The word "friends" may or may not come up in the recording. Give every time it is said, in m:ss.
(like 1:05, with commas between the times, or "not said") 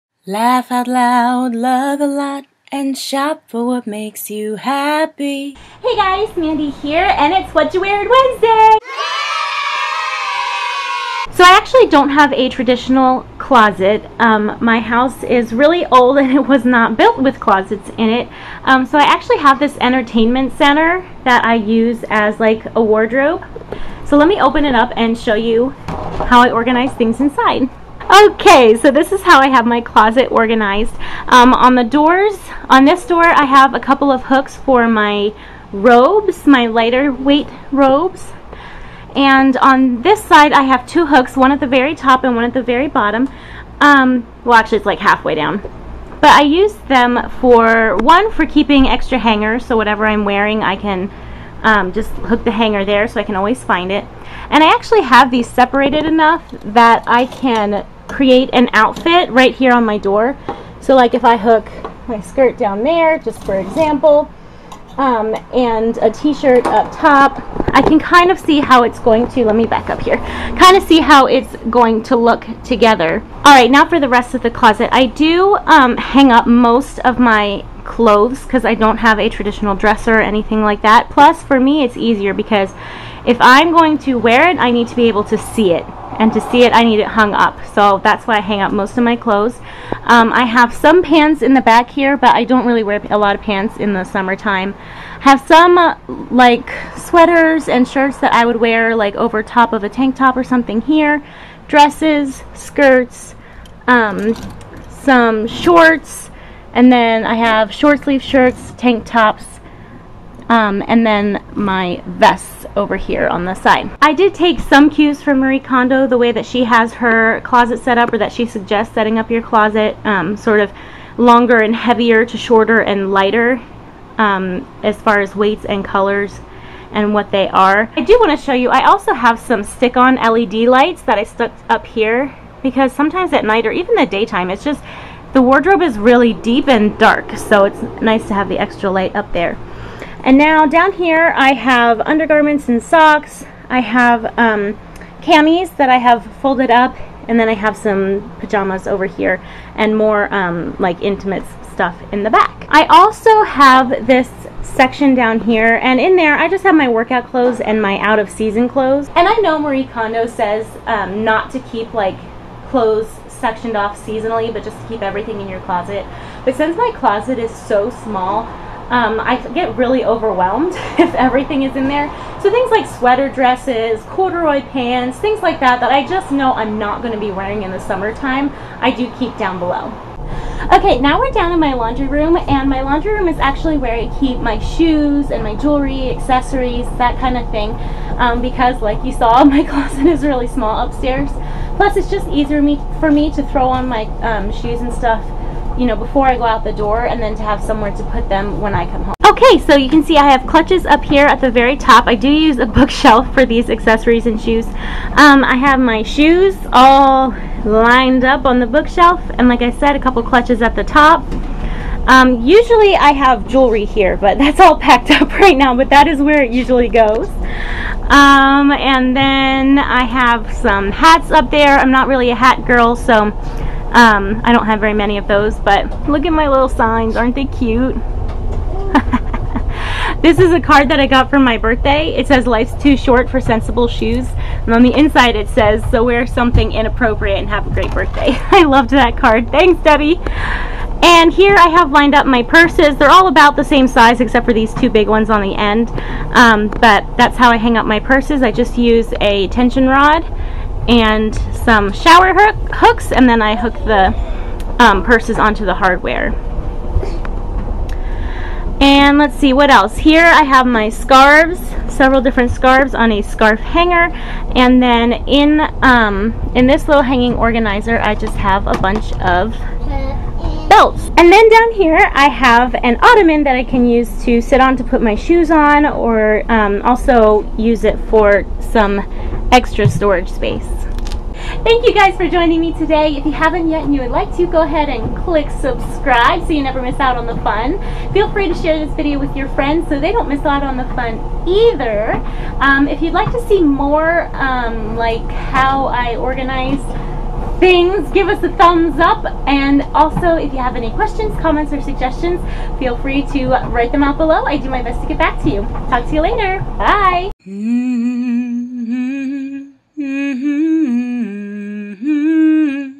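4:49.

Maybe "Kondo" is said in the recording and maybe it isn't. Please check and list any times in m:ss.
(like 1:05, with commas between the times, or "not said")
1:55, 2:39.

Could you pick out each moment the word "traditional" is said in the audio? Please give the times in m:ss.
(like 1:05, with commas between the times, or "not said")
0:12, 1:19.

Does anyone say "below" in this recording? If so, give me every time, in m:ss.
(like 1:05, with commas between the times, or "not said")
2:59, 5:04.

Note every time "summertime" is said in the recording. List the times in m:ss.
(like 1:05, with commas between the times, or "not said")
1:34, 2:57.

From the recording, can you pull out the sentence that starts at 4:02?
They're all about the same size except for these two big ones on the end.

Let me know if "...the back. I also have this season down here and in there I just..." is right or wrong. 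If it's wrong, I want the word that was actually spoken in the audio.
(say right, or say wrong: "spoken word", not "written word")
wrong: "section", not "season".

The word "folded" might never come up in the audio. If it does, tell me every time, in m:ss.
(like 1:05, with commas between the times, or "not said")
2:26.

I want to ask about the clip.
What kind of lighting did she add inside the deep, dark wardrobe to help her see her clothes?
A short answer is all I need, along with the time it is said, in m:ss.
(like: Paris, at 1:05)
Stick-on LED lights, at 2:09.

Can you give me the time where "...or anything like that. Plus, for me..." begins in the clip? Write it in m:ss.
1:20.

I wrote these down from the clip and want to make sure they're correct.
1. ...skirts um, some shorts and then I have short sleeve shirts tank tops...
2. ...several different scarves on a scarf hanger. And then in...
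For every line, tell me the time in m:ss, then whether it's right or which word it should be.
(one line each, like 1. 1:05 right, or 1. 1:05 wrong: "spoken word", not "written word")
1. 1:42 right
2. 4:21 right.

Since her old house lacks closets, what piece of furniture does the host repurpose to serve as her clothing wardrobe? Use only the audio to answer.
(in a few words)
Entertainment center.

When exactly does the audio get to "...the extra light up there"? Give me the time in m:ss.
2:18.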